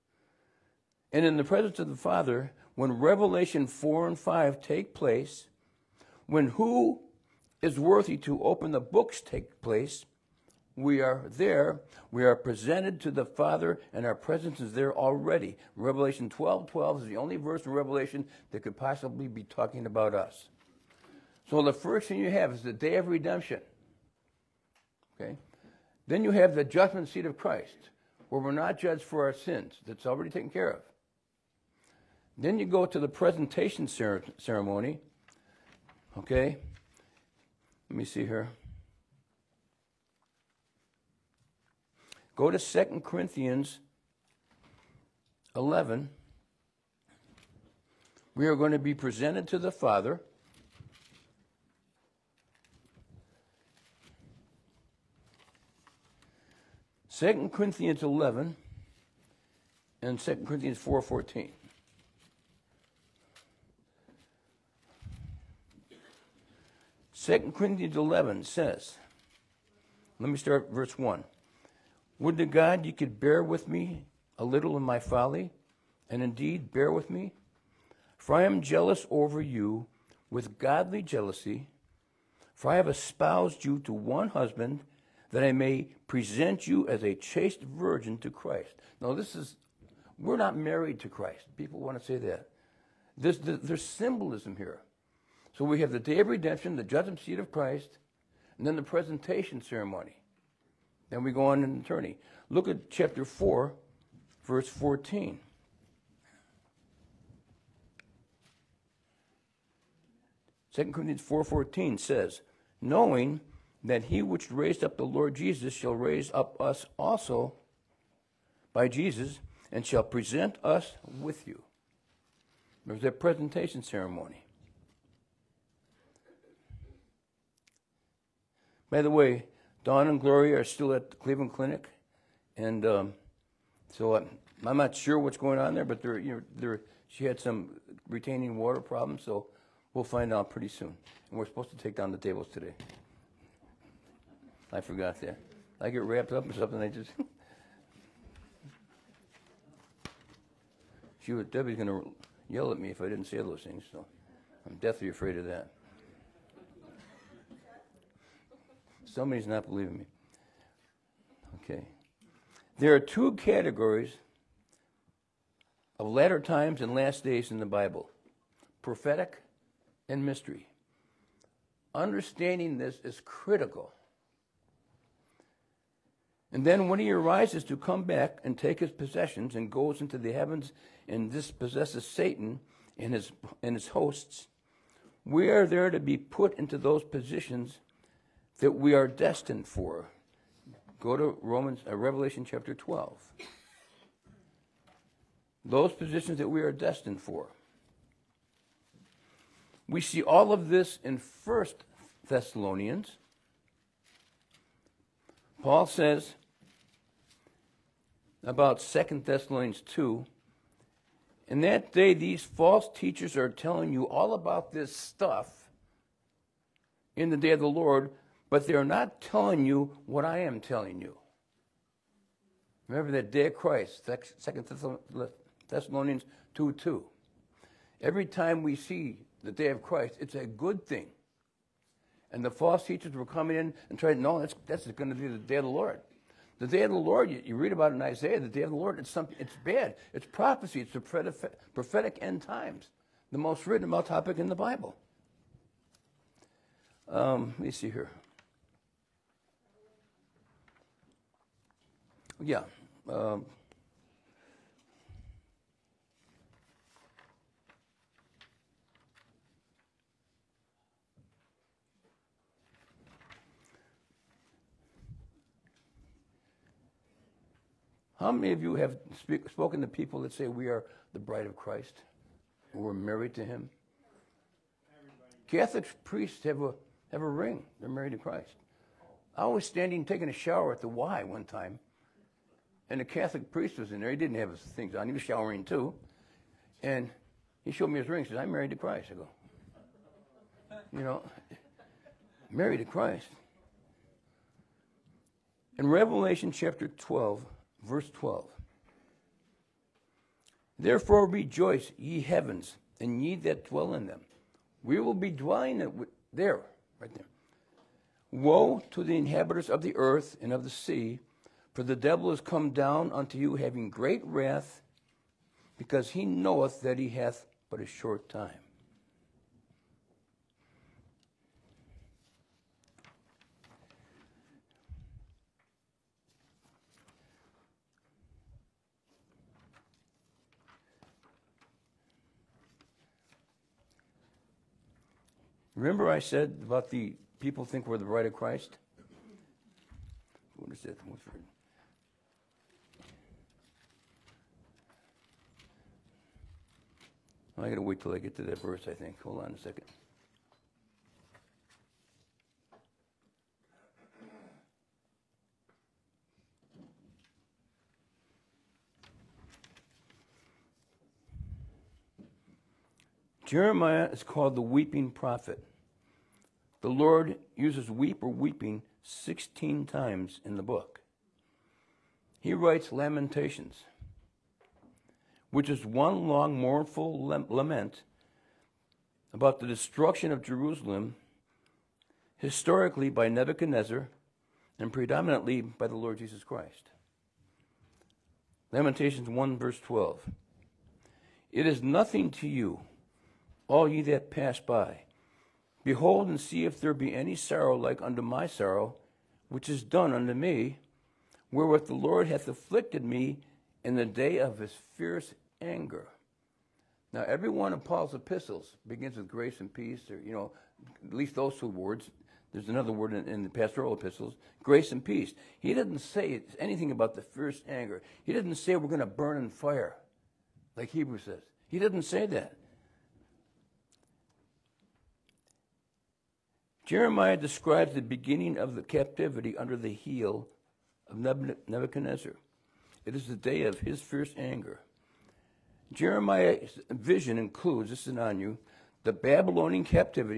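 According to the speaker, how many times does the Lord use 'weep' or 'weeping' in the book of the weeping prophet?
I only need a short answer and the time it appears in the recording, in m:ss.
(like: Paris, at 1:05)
16, at 6:09.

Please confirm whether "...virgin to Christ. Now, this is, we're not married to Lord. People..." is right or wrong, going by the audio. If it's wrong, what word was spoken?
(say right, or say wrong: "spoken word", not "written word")
wrong: "Christ", not "Lord".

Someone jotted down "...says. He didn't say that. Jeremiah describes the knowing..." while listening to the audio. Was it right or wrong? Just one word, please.
wrong.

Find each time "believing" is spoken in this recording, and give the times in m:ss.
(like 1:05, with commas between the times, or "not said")
2:39.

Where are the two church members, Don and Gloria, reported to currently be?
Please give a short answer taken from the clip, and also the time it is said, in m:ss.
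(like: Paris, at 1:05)
Cleveland Clinic, at 2:11.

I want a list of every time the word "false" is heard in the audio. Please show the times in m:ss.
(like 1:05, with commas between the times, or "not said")
3:32, 3:52.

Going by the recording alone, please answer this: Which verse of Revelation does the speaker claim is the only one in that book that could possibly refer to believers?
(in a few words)
Revelation 12:12.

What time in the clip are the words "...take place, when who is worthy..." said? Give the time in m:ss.
0:04.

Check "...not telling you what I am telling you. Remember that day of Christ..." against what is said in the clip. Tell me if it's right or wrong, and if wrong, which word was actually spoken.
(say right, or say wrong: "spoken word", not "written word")
right.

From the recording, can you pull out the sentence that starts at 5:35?
Remember I said about the people think we're the bride of Christ?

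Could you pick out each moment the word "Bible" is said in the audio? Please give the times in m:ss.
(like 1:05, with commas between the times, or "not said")
2:47, 4:04.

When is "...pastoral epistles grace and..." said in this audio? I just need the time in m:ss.
6:53.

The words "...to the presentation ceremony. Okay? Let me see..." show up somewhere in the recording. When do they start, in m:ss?
0:32.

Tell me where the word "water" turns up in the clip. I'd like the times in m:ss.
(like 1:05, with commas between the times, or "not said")
2:18.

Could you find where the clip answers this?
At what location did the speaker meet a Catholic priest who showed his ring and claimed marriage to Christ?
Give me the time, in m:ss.
4:40.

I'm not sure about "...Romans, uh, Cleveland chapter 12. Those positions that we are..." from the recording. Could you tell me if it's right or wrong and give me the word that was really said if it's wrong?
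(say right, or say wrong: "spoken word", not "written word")
wrong: "Revelation", not "Cleveland".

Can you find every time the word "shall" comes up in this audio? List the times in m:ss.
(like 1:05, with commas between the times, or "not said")
1:55, 1:59.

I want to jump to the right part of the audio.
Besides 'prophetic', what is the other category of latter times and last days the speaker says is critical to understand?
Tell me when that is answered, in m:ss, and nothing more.
2:50.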